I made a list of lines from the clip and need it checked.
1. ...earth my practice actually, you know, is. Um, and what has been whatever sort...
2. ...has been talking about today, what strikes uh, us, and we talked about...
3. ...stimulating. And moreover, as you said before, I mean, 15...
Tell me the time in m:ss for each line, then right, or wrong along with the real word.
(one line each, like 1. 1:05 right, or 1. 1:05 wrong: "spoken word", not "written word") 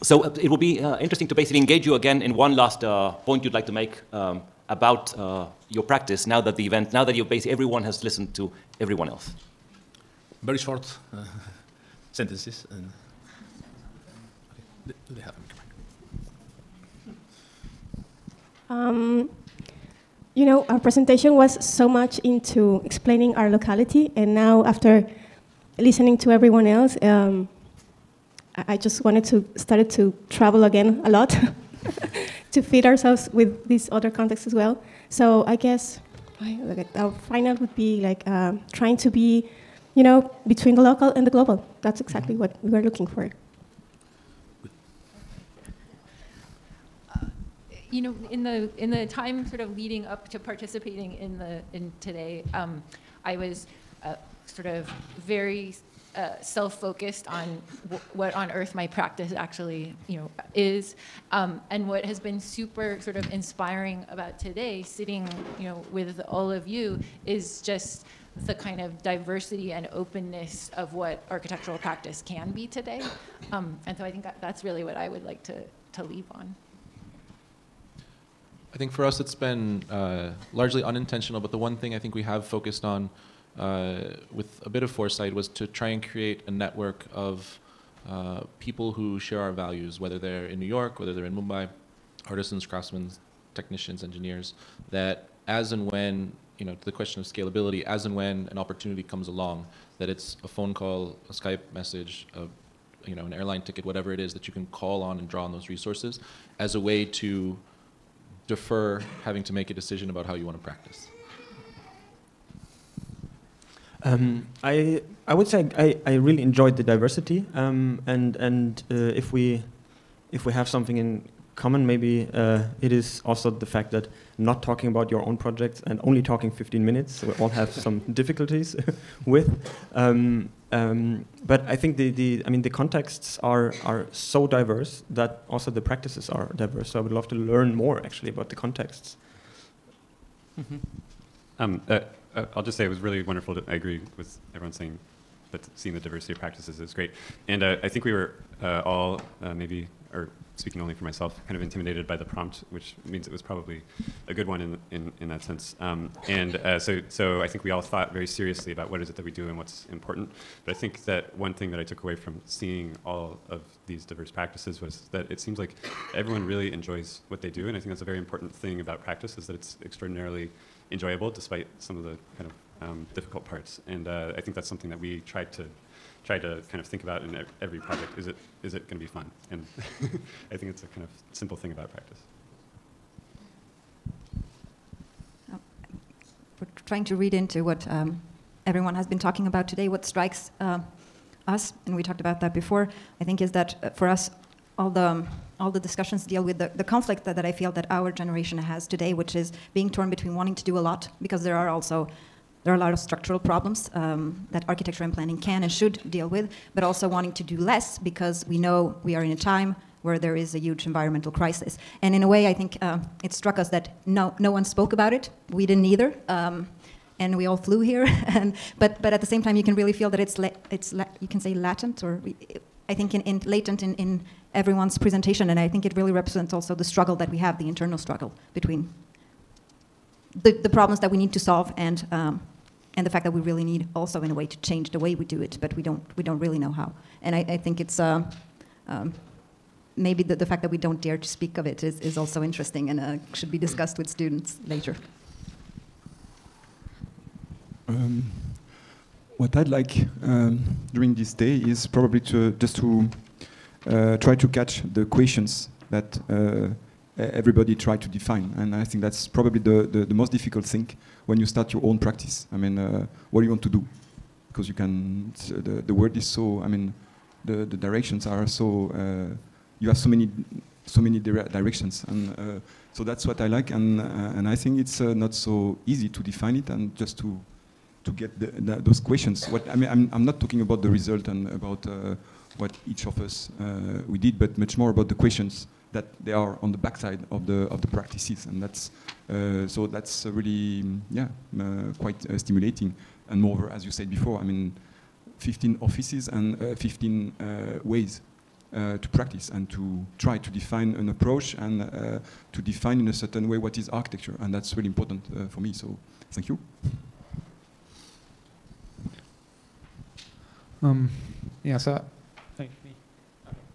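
1. 0:58 wrong: "super", not "whatever"
2. 3:08 right
3. 4:52 right.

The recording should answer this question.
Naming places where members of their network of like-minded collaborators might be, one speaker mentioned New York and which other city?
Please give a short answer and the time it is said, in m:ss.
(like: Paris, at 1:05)
Mumbai, at 1:31.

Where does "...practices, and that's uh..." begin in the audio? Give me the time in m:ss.
4:47.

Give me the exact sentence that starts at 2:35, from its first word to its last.
Um, and uh, so so I think we all thought very seriously about what is it that we do and what's important.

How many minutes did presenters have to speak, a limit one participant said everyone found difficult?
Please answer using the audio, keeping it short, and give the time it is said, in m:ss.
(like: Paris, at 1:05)
15, at 2:06.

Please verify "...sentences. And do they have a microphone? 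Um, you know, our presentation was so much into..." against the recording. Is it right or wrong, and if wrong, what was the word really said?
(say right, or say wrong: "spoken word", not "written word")
right.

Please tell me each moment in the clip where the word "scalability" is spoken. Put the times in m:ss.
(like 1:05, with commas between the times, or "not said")
1:37.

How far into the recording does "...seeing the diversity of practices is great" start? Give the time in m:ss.
2:25.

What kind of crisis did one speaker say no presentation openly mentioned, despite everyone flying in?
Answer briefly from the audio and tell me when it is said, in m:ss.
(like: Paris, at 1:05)
Environmental crisis, at 3:30.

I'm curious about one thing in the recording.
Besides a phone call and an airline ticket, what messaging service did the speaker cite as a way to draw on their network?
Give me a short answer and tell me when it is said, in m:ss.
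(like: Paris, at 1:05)
Skype, at 1:41.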